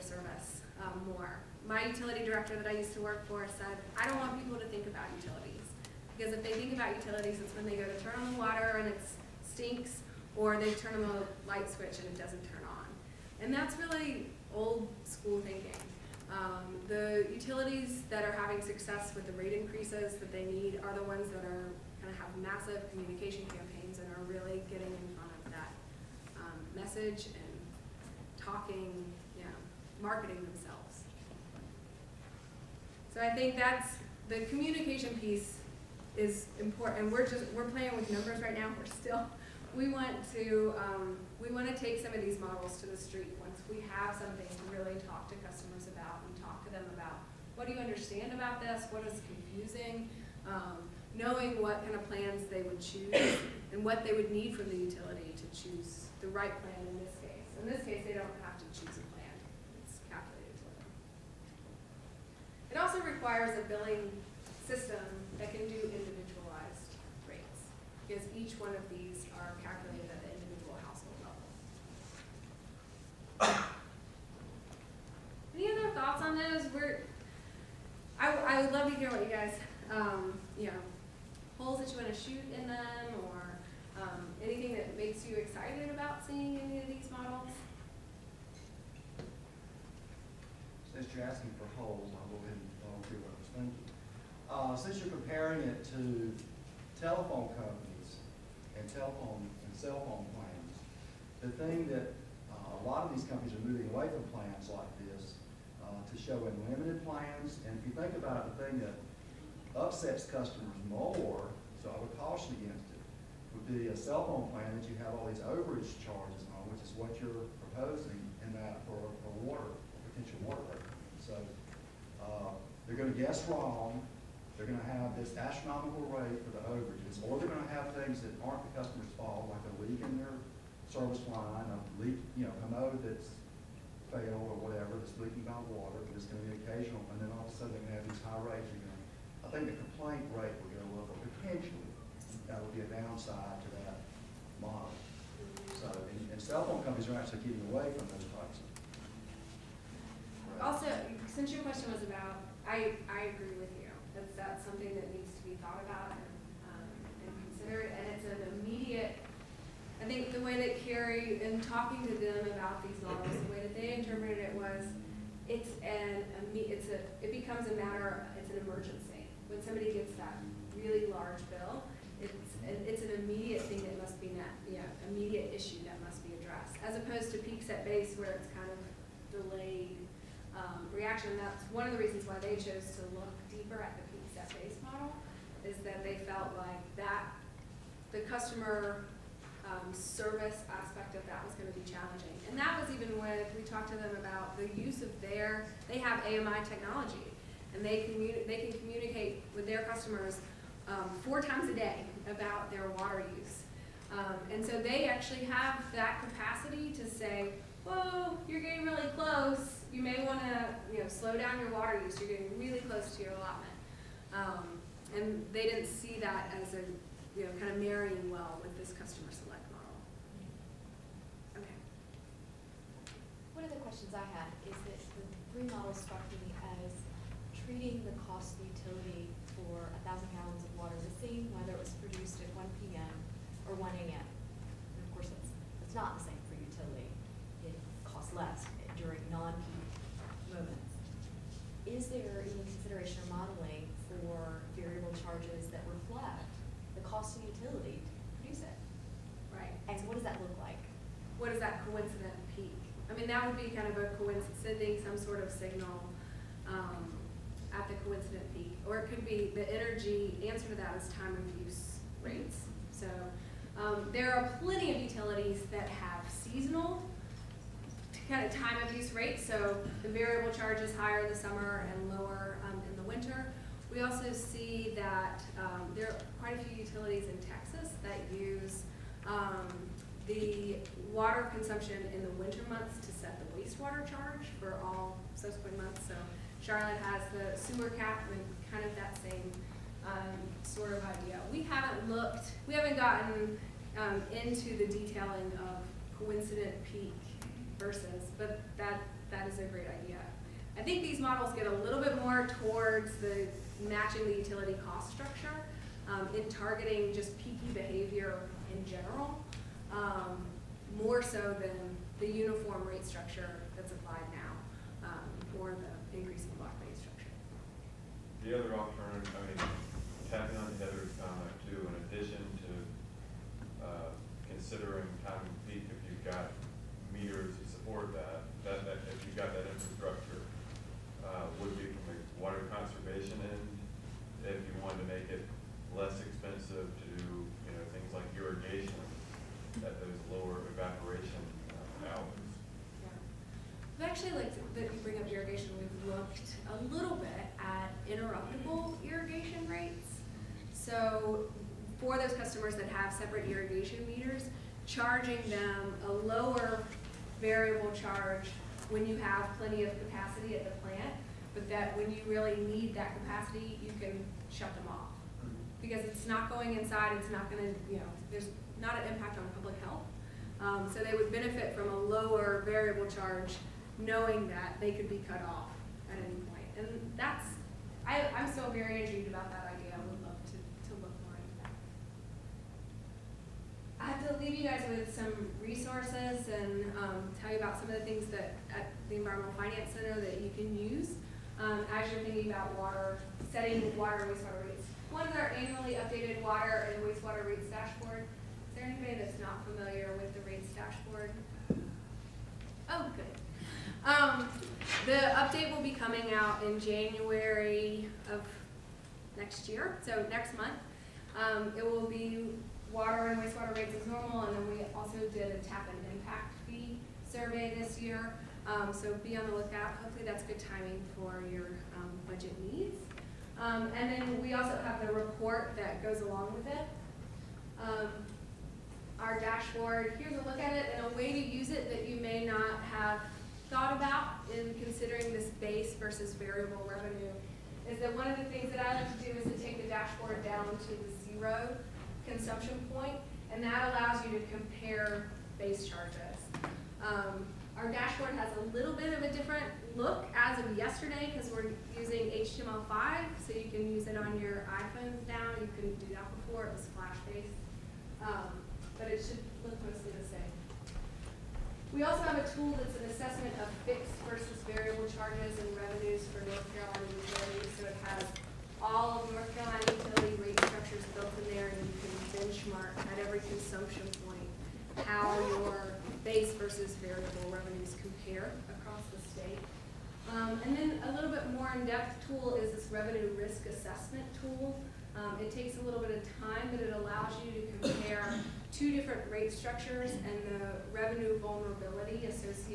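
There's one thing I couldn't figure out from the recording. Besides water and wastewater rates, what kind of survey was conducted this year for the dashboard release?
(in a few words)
tap and impact fee survey.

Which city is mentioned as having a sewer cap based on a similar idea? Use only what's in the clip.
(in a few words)
Charlotte.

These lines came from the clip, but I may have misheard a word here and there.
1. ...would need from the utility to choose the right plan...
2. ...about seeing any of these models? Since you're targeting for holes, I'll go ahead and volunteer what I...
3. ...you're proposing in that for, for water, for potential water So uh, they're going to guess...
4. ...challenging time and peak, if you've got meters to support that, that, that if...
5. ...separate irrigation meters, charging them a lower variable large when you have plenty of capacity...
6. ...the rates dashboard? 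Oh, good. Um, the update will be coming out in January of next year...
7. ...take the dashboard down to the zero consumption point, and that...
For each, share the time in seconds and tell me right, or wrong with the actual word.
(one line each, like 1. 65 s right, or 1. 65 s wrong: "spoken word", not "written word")
1. 54 s right
2. 85 s wrong: "asking", not "targeting"
3. 117 s right
4. 324 s wrong: "considering", not "challenging"
5. 353 s wrong: "charge", not "large"
6. 400 s right
7. 439 s right.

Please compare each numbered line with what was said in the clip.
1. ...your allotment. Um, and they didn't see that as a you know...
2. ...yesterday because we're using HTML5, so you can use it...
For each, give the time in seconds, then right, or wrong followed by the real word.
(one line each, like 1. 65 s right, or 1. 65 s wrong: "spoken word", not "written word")
1. 213 s right
2. 450 s right.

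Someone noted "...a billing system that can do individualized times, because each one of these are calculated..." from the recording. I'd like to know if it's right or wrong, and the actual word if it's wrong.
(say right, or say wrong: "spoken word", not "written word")
wrong: "rates", not "times".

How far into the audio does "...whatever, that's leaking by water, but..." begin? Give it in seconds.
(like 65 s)
134 s.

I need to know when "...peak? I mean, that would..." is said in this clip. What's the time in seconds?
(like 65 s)
252 s.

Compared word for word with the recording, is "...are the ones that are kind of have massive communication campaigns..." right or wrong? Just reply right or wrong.
right.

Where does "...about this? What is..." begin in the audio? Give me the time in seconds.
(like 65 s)
48 s.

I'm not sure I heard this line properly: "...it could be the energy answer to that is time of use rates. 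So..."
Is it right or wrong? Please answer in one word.
right.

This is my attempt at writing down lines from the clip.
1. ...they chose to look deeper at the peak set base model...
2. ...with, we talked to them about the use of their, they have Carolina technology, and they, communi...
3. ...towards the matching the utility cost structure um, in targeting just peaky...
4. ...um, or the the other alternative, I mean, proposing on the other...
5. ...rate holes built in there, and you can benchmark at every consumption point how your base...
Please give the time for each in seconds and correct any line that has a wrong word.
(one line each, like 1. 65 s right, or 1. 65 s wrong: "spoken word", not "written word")
1. 182 s right
2. 193 s wrong: "AMI", not "Carolina"
3. 302 s right
4. 315 s wrong: "tapping", not "proposing"
5. 470 s wrong: "structures", not "holes".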